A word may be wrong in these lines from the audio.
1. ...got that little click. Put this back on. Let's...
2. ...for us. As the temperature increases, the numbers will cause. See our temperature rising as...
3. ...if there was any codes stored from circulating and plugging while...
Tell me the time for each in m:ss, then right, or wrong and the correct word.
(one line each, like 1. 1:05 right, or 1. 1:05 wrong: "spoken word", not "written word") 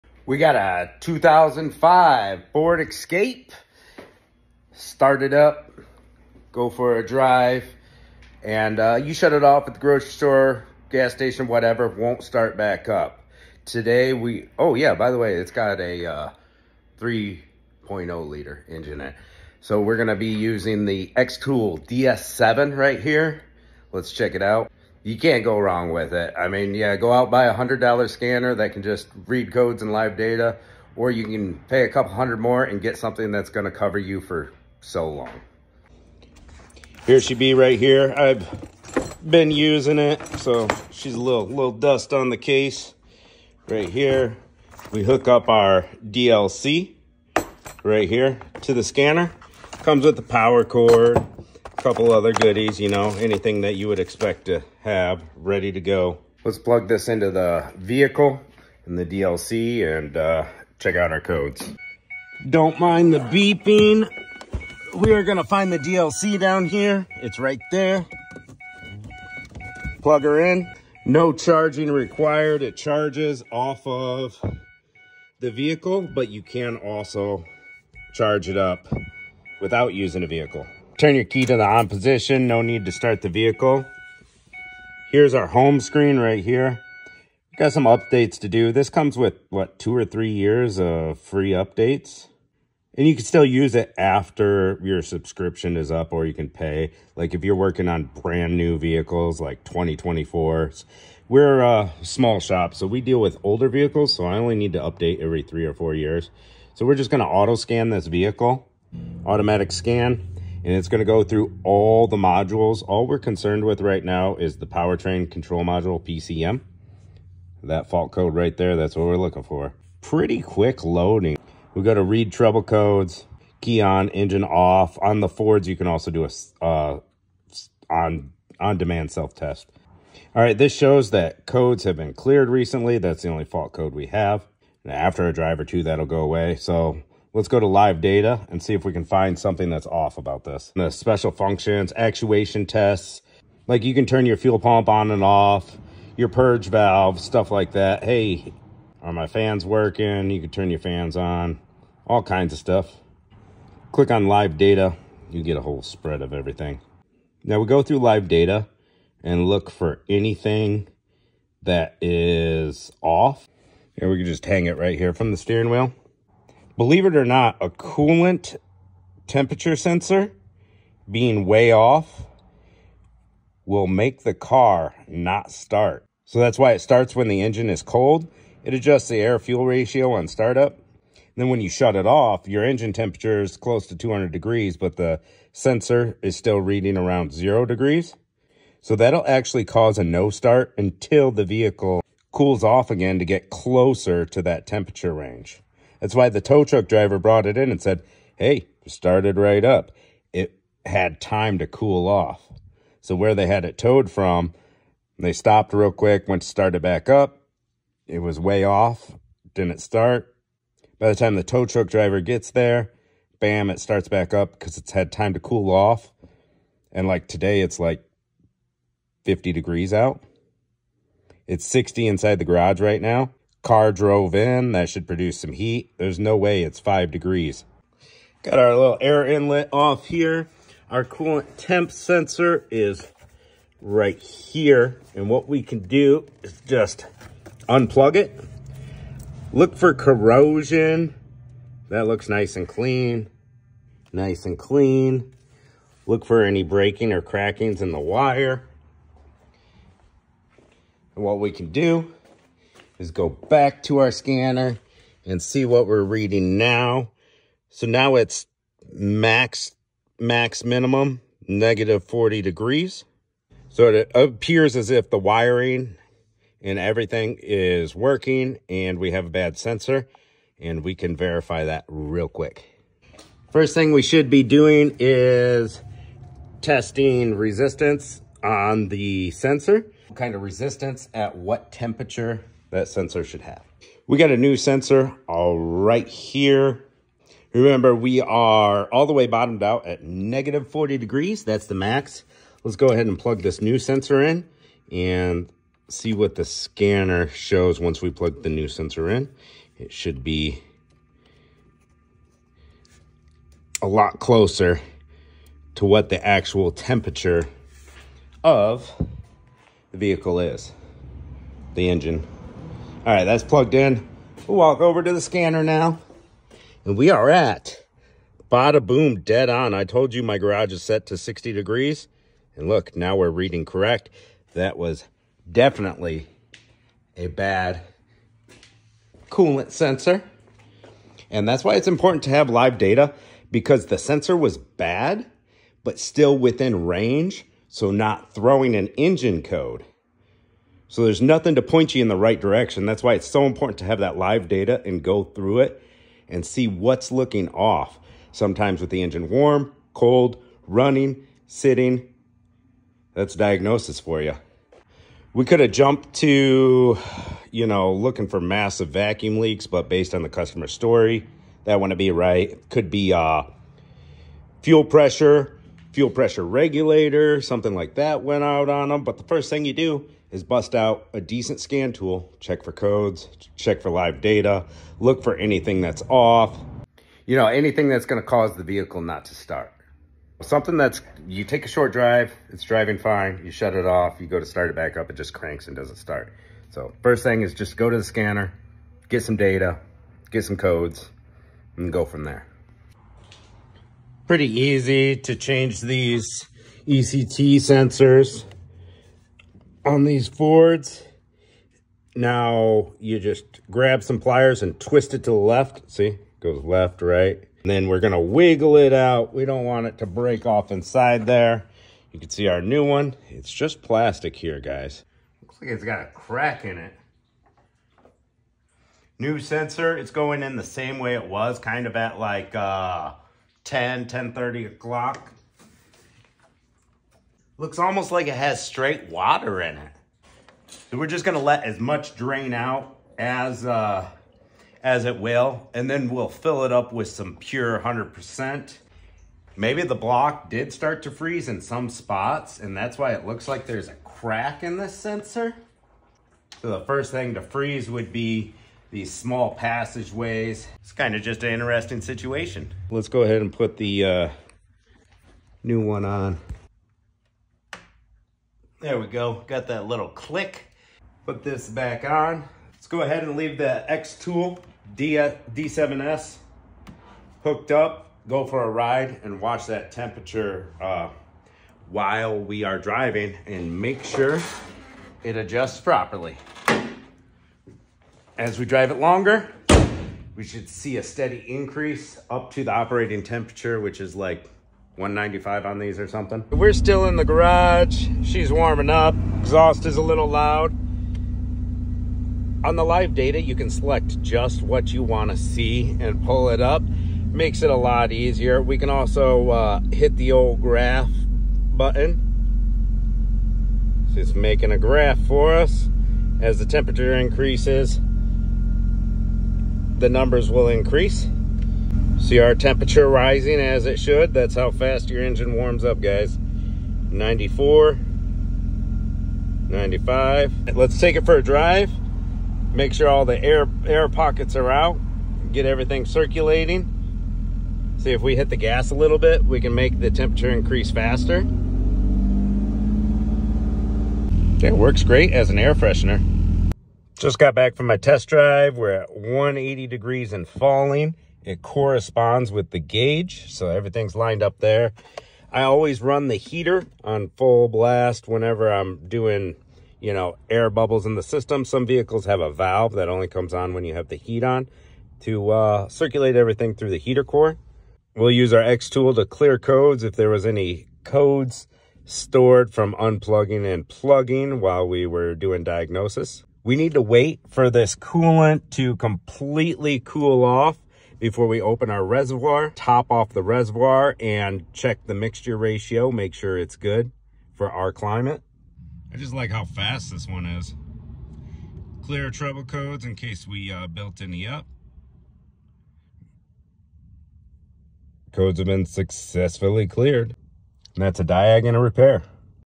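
1. 7:39 right
2. 8:25 wrong: "increase", not "cause"
3. 9:20 wrong: "unplugging", not "circulating".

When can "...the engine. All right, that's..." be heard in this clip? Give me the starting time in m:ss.
5:11.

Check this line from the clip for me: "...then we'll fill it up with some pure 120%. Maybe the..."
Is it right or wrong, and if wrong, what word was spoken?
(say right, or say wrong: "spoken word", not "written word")
wrong: "100", not "120".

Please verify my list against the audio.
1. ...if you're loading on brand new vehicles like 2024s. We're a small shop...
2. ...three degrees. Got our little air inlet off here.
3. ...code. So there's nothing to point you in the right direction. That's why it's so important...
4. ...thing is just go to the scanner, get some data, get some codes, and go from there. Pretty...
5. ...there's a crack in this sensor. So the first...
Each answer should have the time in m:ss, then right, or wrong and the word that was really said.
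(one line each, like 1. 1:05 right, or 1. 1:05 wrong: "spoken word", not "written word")
1. 1:37 wrong: "working", not "loading"
2. 3:46 wrong: "five", not "three"
3. 5:39 right
4. 6:27 right
5. 7:23 right.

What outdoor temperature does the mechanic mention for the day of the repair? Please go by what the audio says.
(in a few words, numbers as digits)
50 degrees.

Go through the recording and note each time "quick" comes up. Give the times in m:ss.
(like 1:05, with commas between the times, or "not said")
2:00, 3:25, 4:32.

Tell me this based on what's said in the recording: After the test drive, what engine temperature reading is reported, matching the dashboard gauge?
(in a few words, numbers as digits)
180 degrees.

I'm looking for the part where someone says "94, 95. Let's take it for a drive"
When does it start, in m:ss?
8:37.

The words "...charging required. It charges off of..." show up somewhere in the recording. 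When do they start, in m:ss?
1:11.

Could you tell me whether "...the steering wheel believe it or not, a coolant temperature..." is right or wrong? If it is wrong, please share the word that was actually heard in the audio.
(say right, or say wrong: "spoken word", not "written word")
right.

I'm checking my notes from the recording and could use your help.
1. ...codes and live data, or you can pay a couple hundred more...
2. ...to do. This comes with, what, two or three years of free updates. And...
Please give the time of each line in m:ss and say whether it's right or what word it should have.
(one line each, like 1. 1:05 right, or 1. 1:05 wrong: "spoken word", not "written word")
1. 0:29 right
2. 1:28 right.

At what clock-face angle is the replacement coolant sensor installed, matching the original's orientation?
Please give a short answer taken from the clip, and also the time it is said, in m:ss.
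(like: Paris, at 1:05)
10:30, at 7:04.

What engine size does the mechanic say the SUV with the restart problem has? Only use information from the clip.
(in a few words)
3.0 liter.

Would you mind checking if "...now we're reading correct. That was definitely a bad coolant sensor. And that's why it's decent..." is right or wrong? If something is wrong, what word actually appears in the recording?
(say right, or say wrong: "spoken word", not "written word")
wrong: "important", not "decent".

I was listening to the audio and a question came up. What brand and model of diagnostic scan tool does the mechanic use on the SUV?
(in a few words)
Xtool DS7.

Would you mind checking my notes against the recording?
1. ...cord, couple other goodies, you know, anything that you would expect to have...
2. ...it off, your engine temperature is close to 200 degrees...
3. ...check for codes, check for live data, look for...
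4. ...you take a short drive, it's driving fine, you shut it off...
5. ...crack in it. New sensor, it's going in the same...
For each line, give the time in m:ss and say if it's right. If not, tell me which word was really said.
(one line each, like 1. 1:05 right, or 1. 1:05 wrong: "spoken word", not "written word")
1. 0:50 right
2. 3:01 right
3. 6:12 right
4. 6:21 right
5. 6:56 right.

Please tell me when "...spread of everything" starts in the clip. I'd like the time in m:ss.
2:35.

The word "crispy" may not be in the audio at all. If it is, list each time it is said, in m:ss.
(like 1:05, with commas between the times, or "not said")
not said.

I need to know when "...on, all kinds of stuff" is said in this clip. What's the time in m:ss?
2:31.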